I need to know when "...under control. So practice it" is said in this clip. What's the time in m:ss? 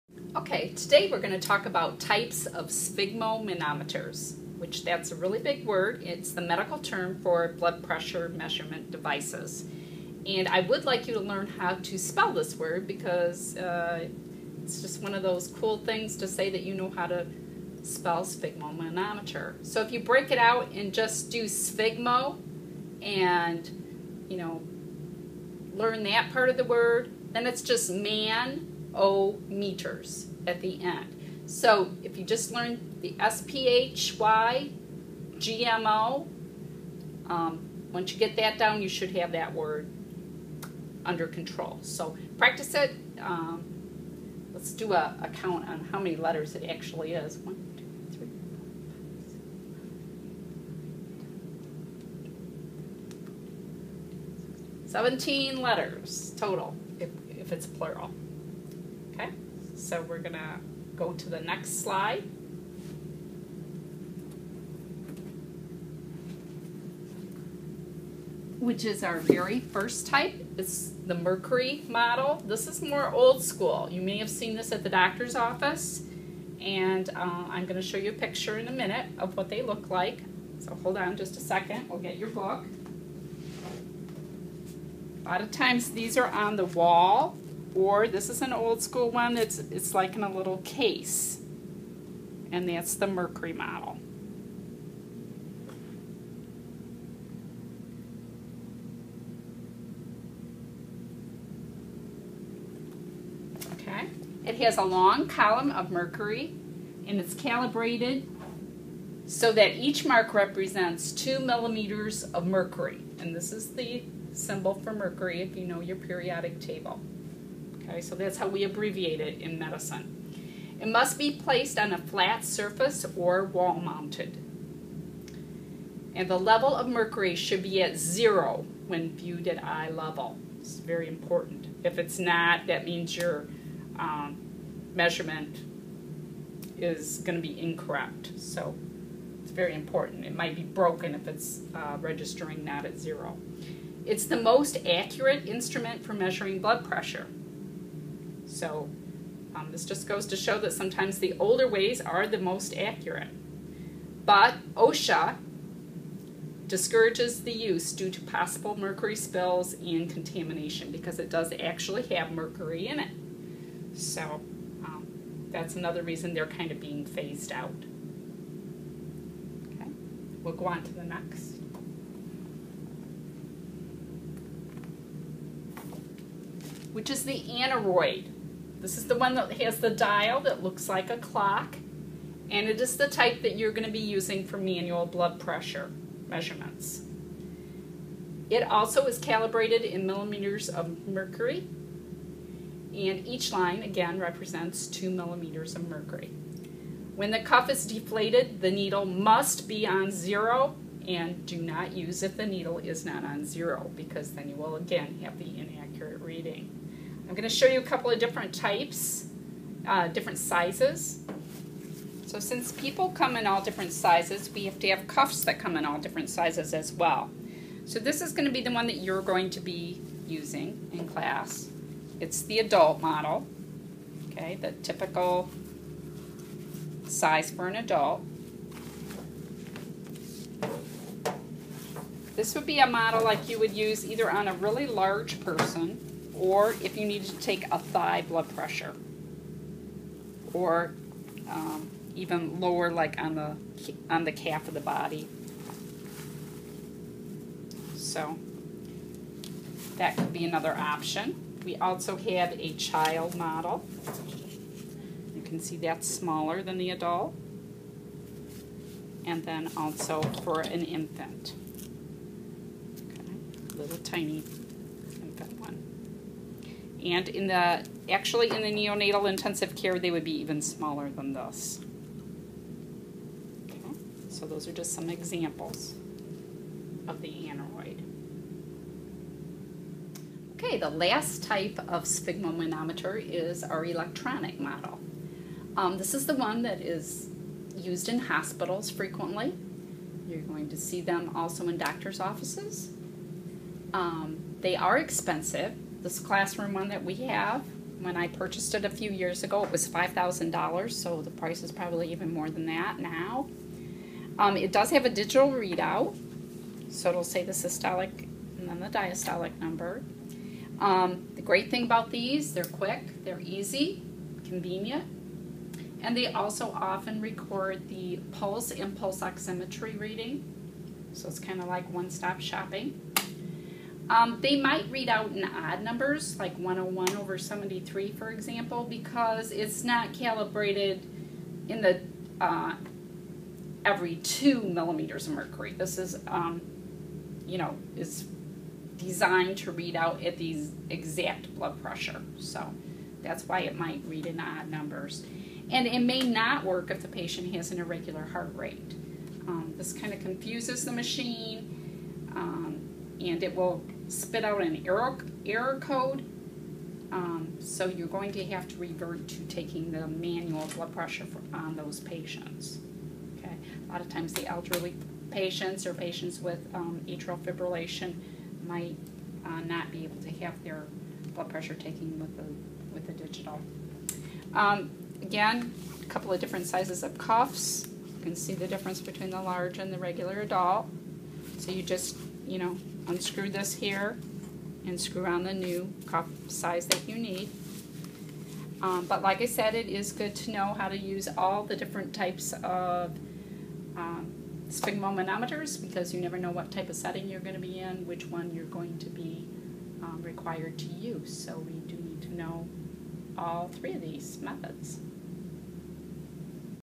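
0:41.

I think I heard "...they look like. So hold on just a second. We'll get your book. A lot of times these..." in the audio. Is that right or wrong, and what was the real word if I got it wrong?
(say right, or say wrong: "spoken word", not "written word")
right.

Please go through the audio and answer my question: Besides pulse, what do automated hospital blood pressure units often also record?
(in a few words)
Pulse oximetry.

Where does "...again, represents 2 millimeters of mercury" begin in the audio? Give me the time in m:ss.
3:13.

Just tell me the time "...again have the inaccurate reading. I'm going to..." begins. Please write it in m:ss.
3:24.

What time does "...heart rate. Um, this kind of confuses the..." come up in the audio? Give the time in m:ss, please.
5:48.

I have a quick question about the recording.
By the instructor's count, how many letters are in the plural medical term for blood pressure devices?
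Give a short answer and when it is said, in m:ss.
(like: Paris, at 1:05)
17, at 0:54.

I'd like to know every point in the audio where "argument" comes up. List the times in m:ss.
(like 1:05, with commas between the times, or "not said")
not said.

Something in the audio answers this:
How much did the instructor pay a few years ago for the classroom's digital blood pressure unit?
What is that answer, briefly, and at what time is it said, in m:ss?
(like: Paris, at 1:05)
$5,000, at 4:59.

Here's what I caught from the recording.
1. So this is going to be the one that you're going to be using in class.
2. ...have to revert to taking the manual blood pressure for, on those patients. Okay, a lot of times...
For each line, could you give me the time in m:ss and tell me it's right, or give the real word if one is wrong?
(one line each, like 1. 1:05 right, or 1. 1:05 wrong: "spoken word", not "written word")
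1. 3:37 right
2. 5:58 right.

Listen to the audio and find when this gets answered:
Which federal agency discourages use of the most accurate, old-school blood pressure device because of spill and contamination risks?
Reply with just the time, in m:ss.
2:34.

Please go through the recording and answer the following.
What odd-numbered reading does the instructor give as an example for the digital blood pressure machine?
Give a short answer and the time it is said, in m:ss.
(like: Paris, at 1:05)
101 over 73, at 5:26.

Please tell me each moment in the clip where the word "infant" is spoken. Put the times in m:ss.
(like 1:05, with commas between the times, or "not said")
4:20, 4:25.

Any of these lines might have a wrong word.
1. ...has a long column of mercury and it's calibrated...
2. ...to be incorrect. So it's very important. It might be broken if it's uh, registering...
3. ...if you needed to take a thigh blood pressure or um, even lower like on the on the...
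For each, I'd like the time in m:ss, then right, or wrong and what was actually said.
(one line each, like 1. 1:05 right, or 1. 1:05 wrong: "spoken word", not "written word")
1. 1:44 right
2. 2:17 right
3. 3:56 right.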